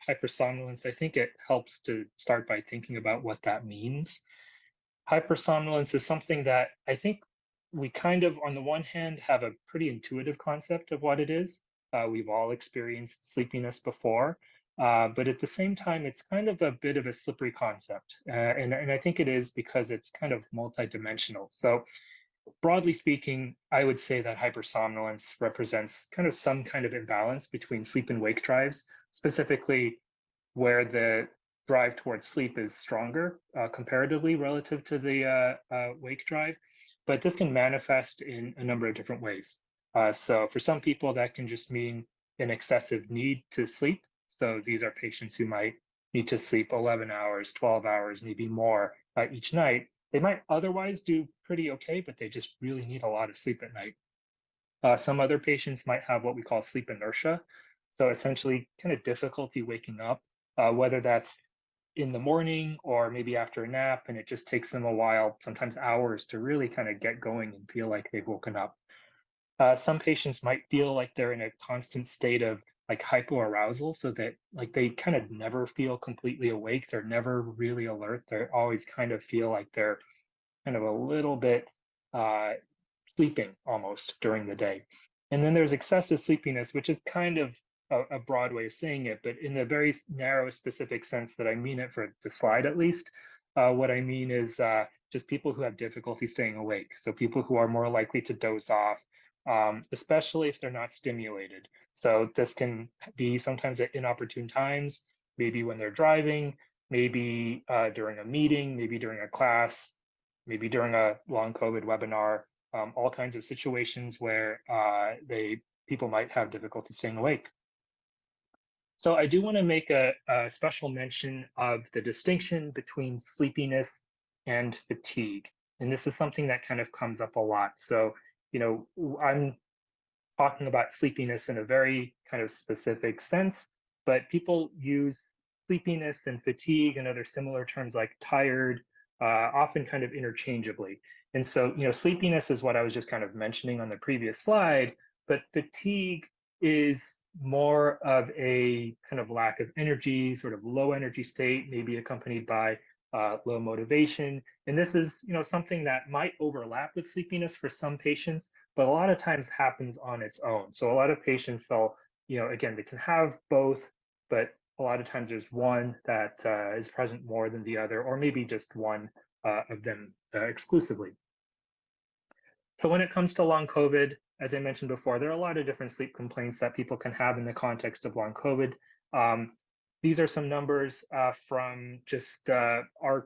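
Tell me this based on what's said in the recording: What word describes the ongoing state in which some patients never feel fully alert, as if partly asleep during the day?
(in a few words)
hypoarousal.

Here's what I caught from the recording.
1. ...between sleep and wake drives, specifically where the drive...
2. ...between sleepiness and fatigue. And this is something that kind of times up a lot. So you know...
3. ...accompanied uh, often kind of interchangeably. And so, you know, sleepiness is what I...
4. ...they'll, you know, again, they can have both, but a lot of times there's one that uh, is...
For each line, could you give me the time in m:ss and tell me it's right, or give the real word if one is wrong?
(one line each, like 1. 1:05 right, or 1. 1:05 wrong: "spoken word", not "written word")
1. 0:27 right
2. 2:02 wrong: "comes", not "times"
3. 2:18 wrong: "tired", not "accompanied"
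4. 2:41 right.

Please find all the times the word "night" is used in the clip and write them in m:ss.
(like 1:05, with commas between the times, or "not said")
0:49, 0:53.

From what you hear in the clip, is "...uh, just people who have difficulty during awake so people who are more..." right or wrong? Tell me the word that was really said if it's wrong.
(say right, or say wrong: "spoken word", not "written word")
wrong: "staying", not "during".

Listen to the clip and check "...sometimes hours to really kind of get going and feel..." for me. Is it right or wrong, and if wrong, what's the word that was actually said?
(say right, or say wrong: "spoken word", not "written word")
right.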